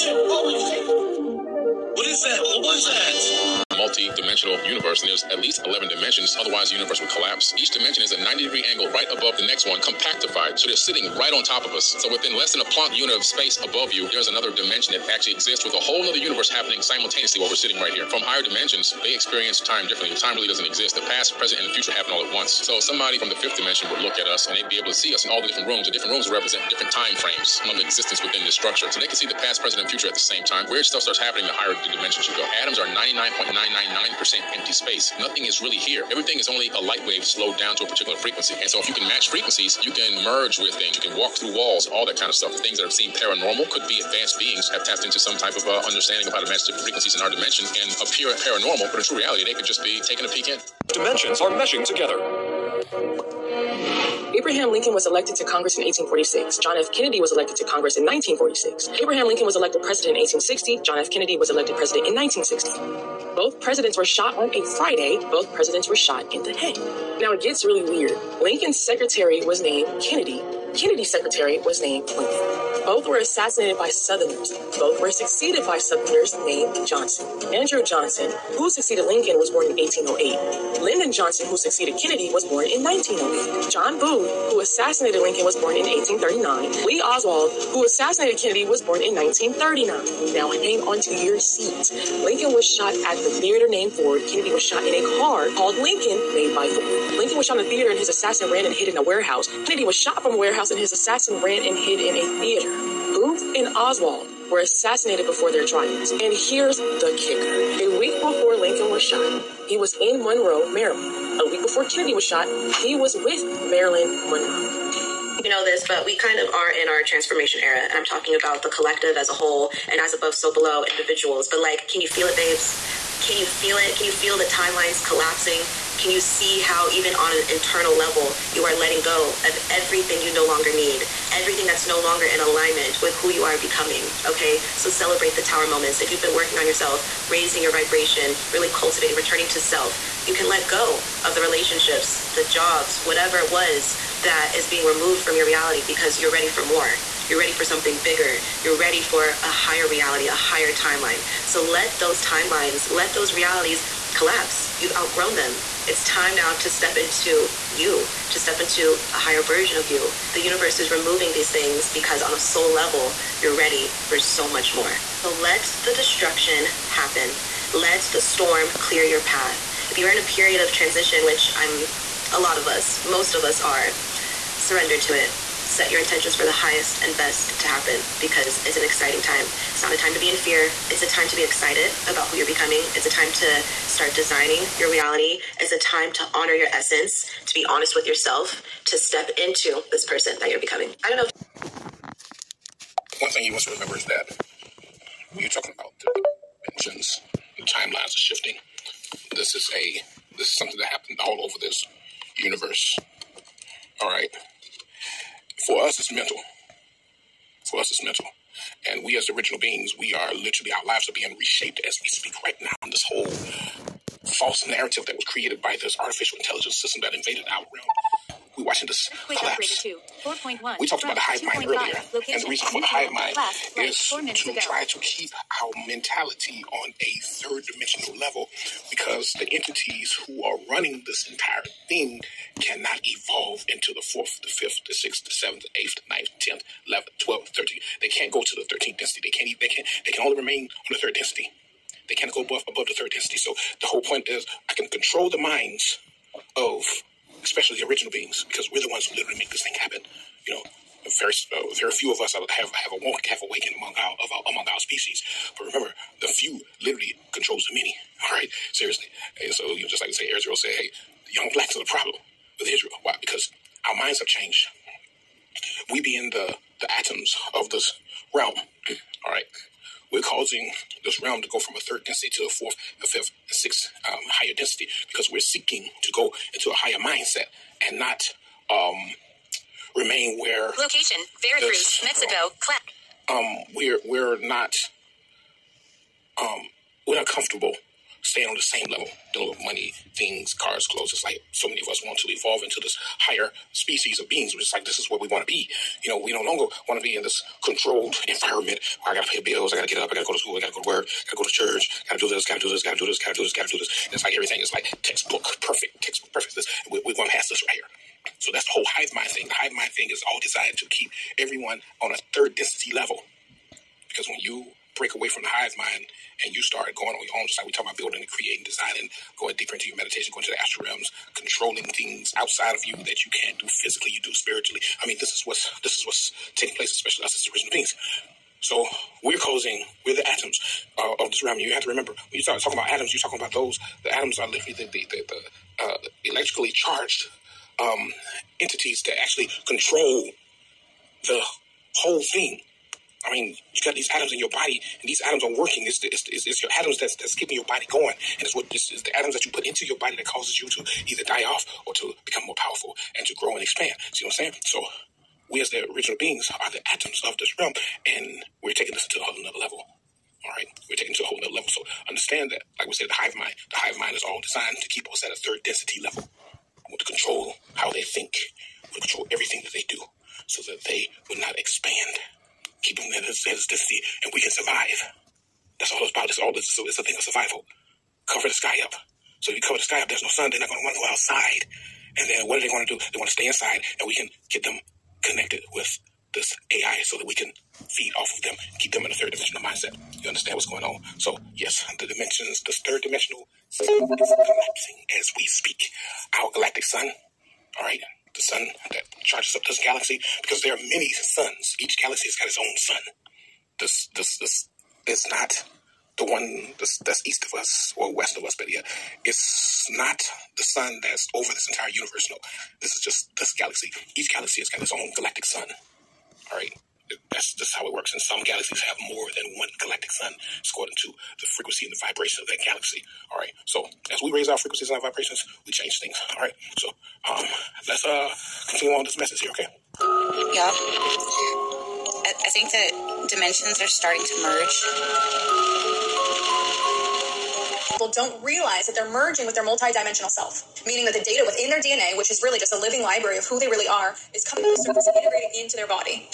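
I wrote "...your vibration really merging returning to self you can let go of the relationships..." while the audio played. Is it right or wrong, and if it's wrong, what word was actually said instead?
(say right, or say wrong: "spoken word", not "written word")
wrong: "cultivating", not "merging".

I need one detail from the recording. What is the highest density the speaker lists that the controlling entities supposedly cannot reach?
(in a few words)
thirteenth density.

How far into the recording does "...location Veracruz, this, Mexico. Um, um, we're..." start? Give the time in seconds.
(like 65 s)
280 s.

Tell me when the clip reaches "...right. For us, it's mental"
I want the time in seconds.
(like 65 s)
204 s.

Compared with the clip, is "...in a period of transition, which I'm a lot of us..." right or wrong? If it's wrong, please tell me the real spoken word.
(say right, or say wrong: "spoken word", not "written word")
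right.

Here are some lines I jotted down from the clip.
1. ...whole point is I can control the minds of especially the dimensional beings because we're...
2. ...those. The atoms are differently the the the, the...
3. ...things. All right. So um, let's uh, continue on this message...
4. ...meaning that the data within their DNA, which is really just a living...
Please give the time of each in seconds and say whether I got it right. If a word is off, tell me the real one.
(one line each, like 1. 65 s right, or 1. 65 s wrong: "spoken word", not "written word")
1. 243 s wrong: "original", not "dimensional"
2. 333 s wrong: "literally", not "differently"
3. 426 s right
4. 440 s right.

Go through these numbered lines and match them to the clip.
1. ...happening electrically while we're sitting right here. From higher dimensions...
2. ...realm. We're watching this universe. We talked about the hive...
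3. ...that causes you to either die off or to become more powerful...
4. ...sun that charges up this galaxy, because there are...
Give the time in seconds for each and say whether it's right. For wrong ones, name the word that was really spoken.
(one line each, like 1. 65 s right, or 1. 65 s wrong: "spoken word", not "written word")
1. 16 s wrong: "simultaneously", not "electrically"
2. 217 s wrong: "collapse", not "universe"
3. 350 s right
4. 398 s right.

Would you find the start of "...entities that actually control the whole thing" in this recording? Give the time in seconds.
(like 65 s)
338 s.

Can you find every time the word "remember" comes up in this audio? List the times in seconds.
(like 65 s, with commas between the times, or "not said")
193 s, 255 s, 331 s.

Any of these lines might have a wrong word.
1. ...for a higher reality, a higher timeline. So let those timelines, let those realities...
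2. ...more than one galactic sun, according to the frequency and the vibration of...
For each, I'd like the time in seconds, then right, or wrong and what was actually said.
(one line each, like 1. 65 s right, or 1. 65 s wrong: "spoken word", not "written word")
1. 148 s right
2. 419 s right.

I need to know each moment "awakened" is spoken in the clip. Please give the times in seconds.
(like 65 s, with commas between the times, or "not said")
253 s.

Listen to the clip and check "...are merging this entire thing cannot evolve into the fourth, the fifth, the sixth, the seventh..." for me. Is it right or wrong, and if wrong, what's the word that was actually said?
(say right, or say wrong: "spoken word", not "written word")
wrong: "running", not "merging".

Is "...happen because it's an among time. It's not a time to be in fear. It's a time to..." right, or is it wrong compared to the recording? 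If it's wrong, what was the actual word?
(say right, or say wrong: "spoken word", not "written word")
wrong: "exciting", not "among".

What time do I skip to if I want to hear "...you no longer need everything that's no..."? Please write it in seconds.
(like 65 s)
130 s.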